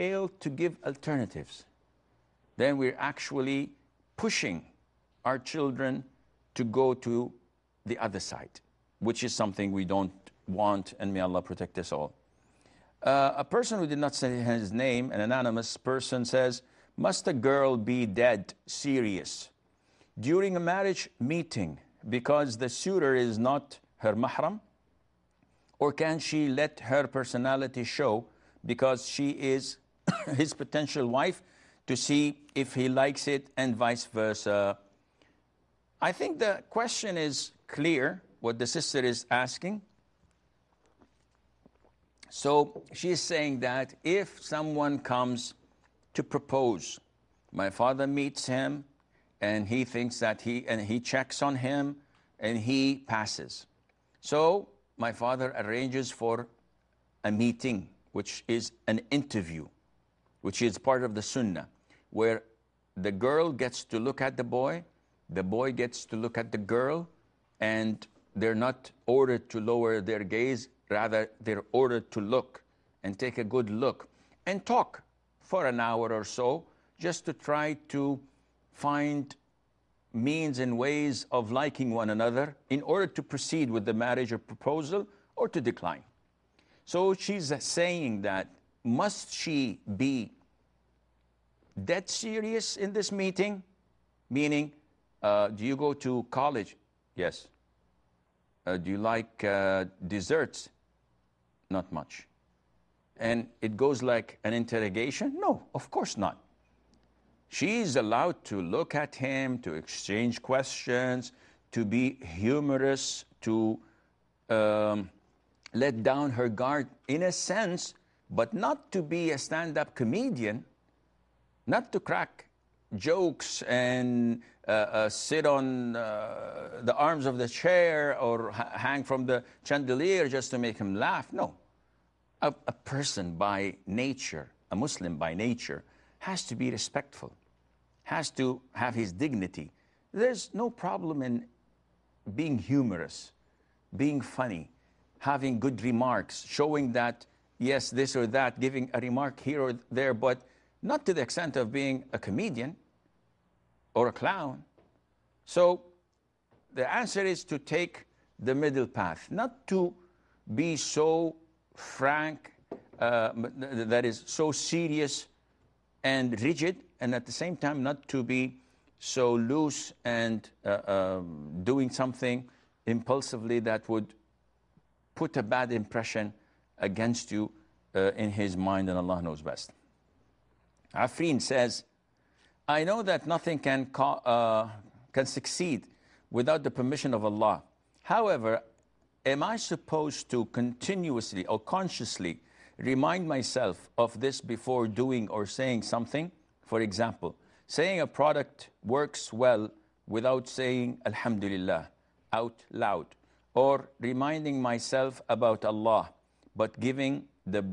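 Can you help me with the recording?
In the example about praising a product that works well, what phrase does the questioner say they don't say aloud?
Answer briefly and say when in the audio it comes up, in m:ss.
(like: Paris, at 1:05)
Alhamdulillah, at 3:21.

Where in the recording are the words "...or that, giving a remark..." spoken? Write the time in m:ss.
2:28.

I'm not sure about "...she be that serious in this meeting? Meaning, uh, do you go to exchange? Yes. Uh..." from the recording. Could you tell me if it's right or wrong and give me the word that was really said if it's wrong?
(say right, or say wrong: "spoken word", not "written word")
wrong: "college", not "exchange".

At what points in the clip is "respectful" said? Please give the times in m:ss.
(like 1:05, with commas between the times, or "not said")
2:16.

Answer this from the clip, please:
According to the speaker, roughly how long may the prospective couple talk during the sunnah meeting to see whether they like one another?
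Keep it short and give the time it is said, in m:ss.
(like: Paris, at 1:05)
an hour, at 1:15.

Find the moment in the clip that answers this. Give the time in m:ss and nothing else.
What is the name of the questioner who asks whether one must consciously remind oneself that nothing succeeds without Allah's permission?
3:00.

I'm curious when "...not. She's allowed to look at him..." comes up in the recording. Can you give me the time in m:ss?
1:46.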